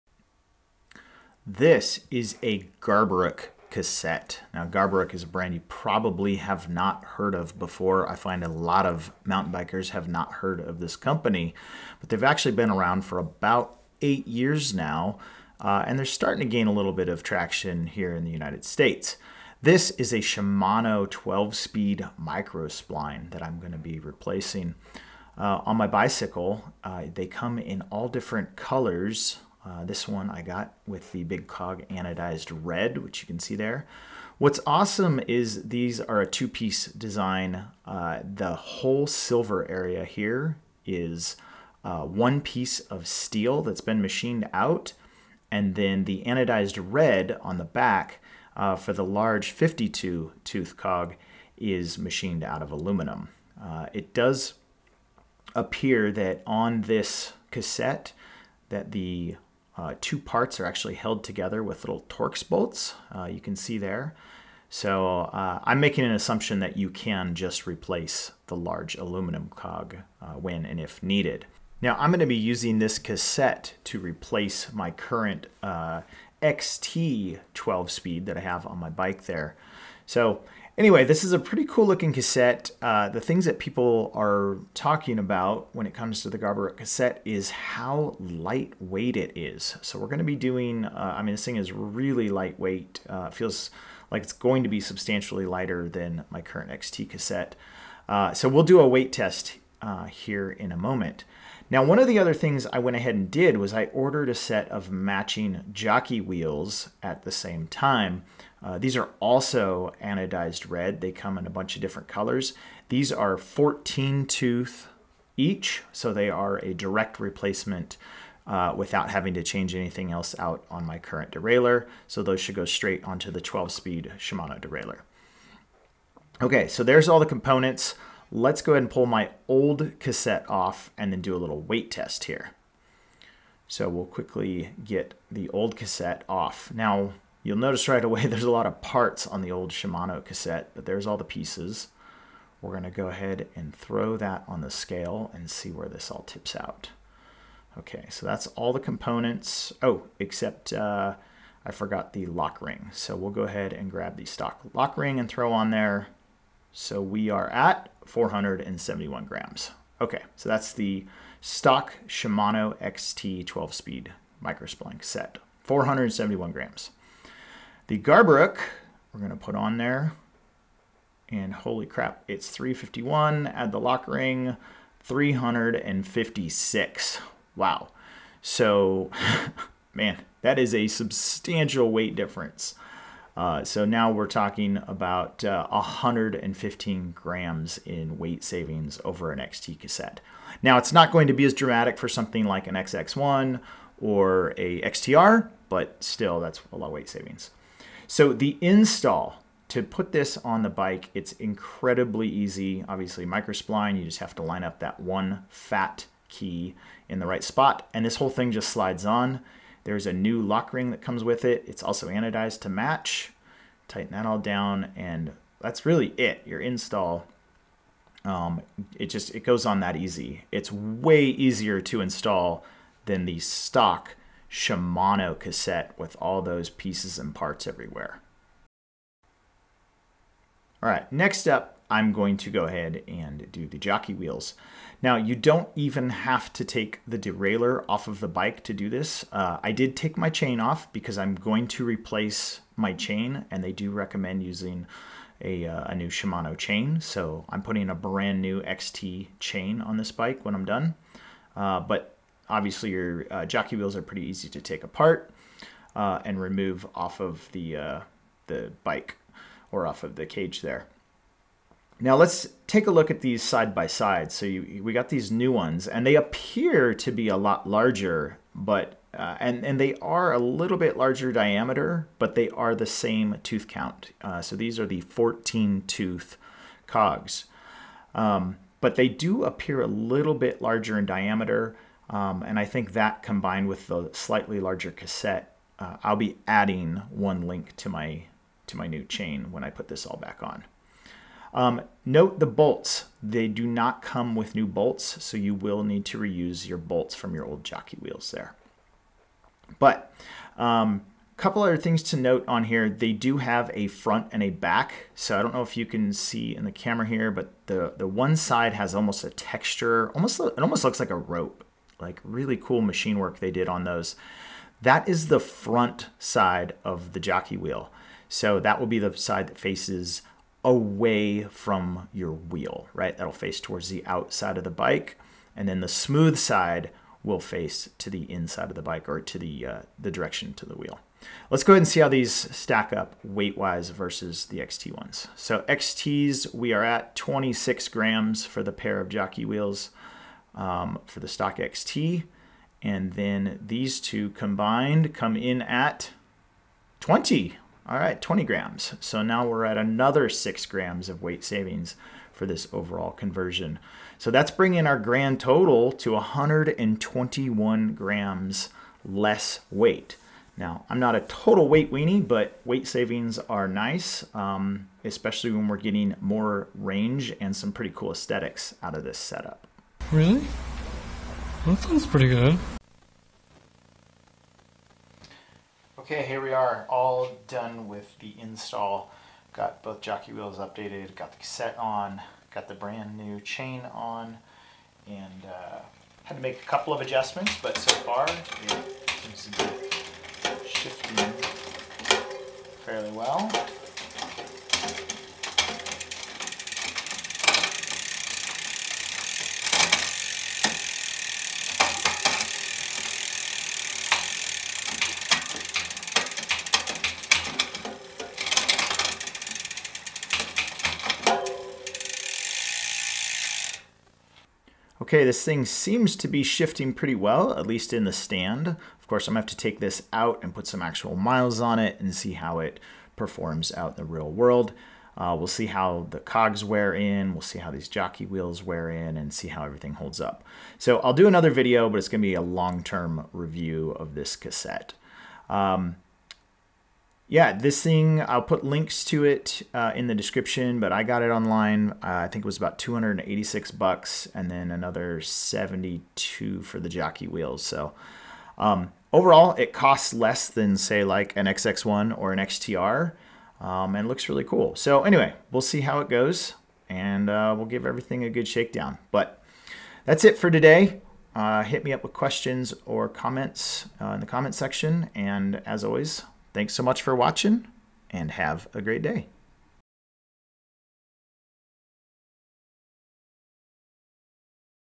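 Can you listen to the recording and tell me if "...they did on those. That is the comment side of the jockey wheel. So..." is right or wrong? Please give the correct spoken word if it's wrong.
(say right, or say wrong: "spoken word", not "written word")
wrong: "front", not "comment".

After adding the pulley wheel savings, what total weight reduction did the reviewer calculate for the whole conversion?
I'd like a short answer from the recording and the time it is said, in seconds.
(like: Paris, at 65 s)
121 grams, at 356 s.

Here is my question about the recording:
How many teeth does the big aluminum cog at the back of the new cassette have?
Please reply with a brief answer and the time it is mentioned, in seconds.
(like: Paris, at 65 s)
52, at 49 s.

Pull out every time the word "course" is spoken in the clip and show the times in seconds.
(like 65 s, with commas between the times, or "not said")
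419 s.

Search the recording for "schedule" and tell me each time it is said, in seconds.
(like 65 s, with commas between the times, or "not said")
not said.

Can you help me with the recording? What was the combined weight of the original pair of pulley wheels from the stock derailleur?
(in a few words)
26 grams.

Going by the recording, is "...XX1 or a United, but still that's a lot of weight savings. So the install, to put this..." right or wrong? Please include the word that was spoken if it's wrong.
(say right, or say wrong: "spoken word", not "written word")
wrong: "XTR", not "United".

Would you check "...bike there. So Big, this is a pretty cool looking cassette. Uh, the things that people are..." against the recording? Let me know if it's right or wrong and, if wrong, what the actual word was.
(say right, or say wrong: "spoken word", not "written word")
wrong: "Anyway", not "Big".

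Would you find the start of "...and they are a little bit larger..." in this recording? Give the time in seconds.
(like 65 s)
269 s.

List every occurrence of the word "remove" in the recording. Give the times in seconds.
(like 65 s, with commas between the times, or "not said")
256 s.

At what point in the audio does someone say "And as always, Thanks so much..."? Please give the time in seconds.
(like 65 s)
465 s.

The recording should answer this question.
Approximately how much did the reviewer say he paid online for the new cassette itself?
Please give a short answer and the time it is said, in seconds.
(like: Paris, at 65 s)
$286, at 442 s.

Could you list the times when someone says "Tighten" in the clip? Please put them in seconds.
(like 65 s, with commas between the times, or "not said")
213 s.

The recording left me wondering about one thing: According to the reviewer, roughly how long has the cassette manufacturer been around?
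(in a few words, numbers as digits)
8 years.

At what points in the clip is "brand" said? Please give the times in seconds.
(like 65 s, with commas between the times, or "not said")
5 s, 247 s, 382 s.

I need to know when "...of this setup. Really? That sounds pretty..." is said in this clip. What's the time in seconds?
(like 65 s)
368 s.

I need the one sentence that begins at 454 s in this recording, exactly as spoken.
So anyway, we'll see how it goes and uh, we'll give everything a good shakedown.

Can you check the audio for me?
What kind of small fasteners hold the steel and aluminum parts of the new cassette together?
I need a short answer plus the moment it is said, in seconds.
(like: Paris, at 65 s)
Torx bolts, at 62 s.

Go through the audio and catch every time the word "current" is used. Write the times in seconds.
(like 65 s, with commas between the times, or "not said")
74 s, 96 s, 120 s.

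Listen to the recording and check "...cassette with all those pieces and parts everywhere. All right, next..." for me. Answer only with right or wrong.
right.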